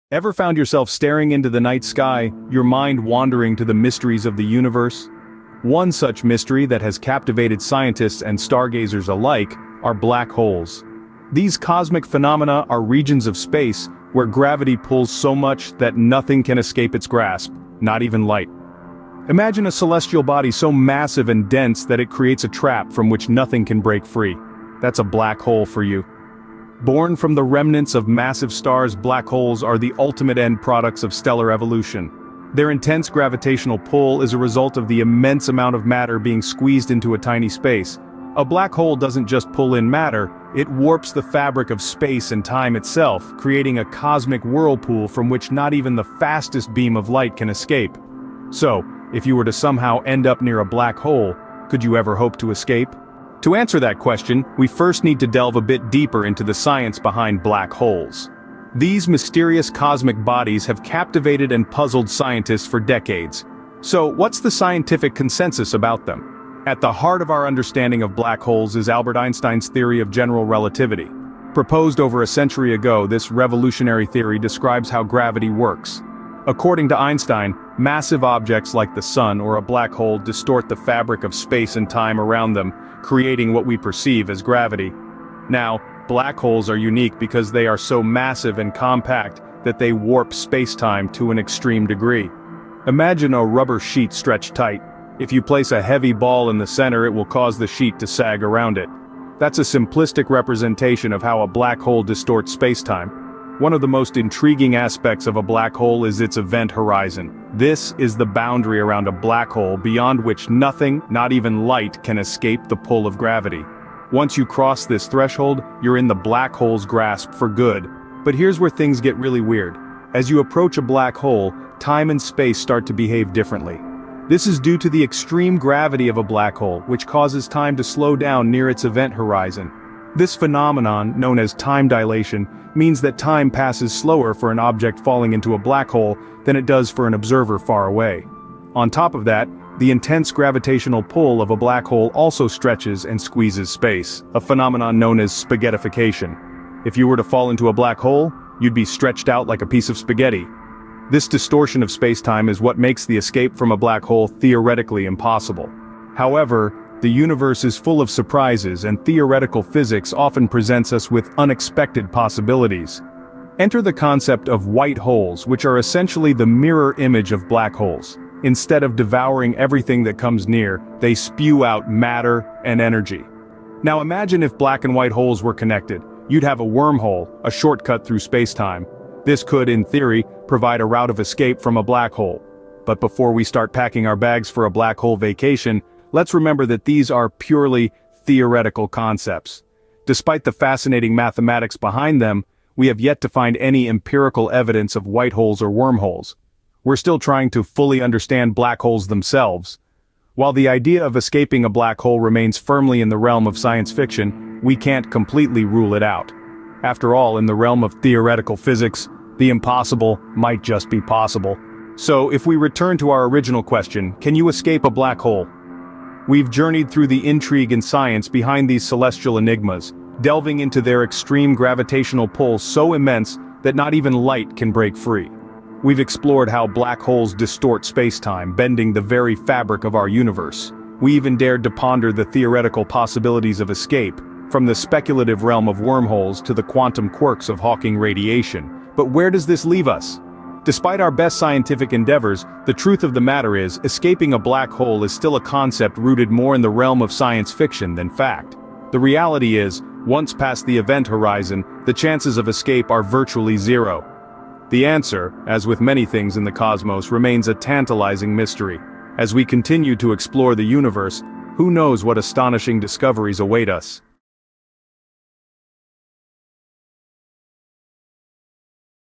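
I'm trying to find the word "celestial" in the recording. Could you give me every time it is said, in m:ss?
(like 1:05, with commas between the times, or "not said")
0:19, 3:38.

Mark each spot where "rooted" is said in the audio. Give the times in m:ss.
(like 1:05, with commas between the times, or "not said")
4:05.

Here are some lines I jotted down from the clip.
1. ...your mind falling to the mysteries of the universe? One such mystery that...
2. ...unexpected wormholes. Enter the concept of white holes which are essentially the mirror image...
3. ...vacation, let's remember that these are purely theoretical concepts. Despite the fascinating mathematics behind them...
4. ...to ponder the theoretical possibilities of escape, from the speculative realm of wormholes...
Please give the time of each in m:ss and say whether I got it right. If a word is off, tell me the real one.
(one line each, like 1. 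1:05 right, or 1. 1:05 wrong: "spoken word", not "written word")
1. 0:02 wrong: "wandering", not "falling"
2. 2:41 wrong: "possibilities", not "wormholes"
3. 3:05 right
4. 3:51 right.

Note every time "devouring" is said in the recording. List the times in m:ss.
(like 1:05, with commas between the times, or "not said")
2:48.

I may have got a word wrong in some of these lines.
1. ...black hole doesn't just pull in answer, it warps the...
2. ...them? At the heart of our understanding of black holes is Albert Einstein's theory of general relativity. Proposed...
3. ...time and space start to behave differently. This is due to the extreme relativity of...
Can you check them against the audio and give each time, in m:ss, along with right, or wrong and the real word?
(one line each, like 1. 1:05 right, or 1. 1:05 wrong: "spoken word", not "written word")
1. 0:38 wrong: "matter", not "answer"
2. 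1:06 right
3. 2:01 wrong: "gravity", not "relativity".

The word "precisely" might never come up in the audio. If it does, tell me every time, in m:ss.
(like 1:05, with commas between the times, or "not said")
not said.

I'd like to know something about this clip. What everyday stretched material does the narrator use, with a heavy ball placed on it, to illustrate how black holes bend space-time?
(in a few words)
rubber sheet.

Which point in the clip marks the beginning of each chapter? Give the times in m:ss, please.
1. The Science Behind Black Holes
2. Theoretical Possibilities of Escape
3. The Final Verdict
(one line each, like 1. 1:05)
1. 0:53
2. 2:35
3. 3:31.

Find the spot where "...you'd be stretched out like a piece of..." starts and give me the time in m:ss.
2:28.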